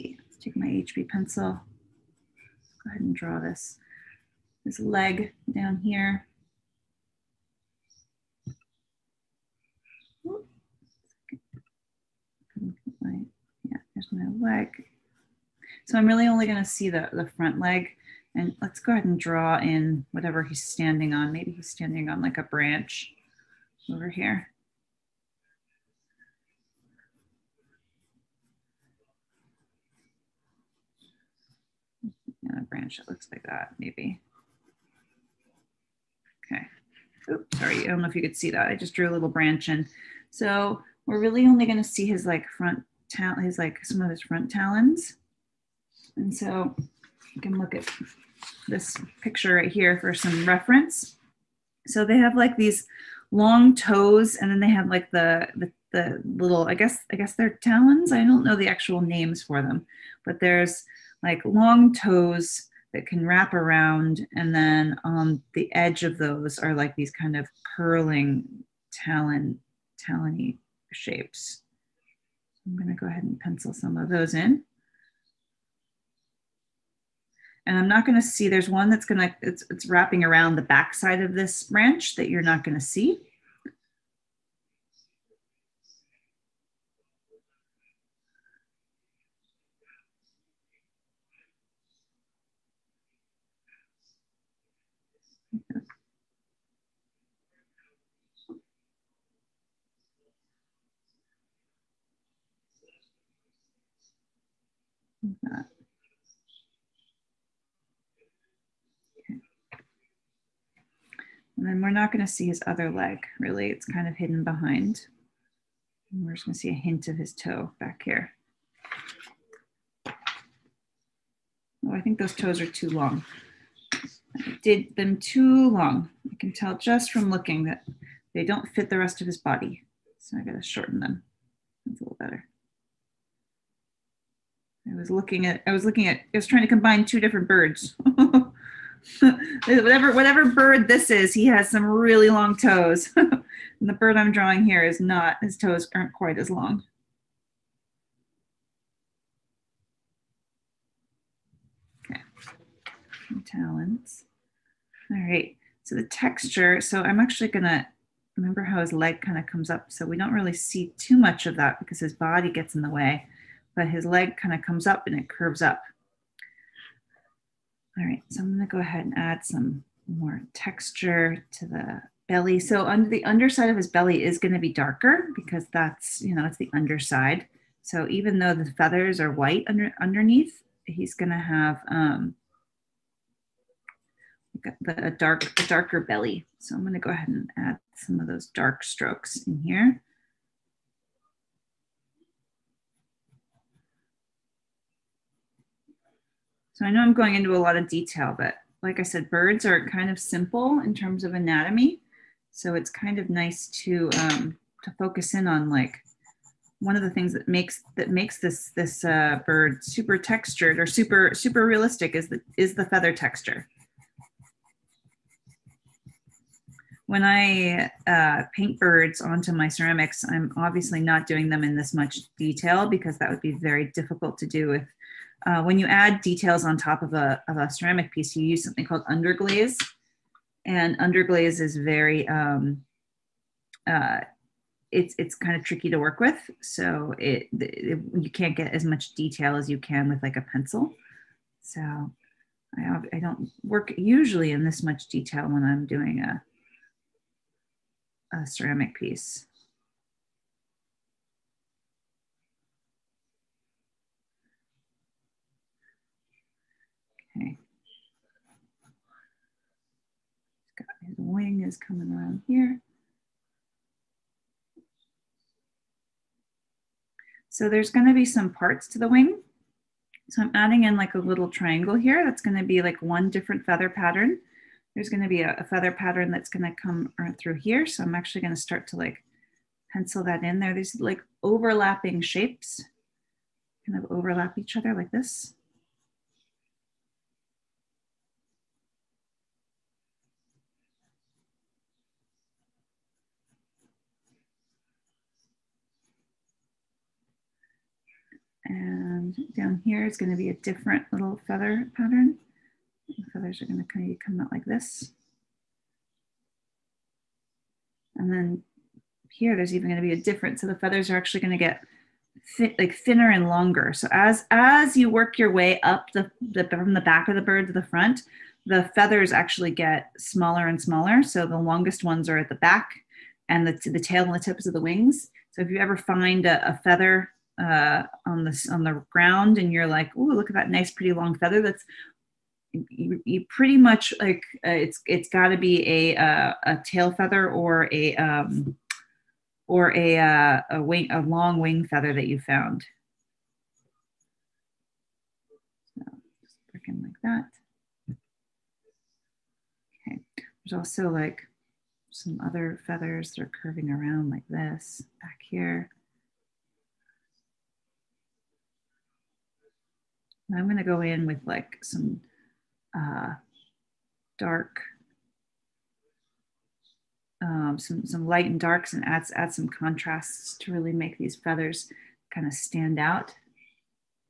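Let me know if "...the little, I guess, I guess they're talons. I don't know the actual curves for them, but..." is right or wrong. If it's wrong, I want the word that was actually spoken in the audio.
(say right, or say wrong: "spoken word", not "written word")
wrong: "names", not "curves".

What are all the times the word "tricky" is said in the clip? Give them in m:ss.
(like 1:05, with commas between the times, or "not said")
3:55.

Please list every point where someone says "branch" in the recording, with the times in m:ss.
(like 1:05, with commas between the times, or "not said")
0:22, 0:32, 0:39, 1:21.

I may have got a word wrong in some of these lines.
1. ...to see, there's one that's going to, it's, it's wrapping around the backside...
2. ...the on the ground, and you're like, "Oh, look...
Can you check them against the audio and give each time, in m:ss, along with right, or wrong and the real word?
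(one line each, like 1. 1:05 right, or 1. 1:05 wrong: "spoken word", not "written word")
1. 1:18 right
2. 5:28 right.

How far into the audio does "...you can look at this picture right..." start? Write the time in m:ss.
0:47.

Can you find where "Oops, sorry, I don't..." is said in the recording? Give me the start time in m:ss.
0:37.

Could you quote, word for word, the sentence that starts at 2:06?
I can tell just from looking that they don't fit the rest of his body.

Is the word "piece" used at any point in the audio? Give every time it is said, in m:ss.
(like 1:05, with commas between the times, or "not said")
3:48, 4:08.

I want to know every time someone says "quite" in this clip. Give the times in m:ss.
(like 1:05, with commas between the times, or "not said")
2:26.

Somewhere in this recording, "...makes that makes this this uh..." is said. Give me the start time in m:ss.
3:27.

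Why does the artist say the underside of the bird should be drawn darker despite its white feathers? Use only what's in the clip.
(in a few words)
It's the underside.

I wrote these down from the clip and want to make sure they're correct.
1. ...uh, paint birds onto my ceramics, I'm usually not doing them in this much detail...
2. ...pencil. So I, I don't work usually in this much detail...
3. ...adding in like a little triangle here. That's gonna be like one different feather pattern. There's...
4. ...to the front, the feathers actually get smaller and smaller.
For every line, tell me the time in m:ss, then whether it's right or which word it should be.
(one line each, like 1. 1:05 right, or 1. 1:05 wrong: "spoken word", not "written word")
1. 3:38 wrong: "obviously", not "usually"
2. 4:00 right
3. 4:30 right
4. 5:17 right.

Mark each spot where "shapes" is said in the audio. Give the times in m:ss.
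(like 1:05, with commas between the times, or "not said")
1:10, 4:42.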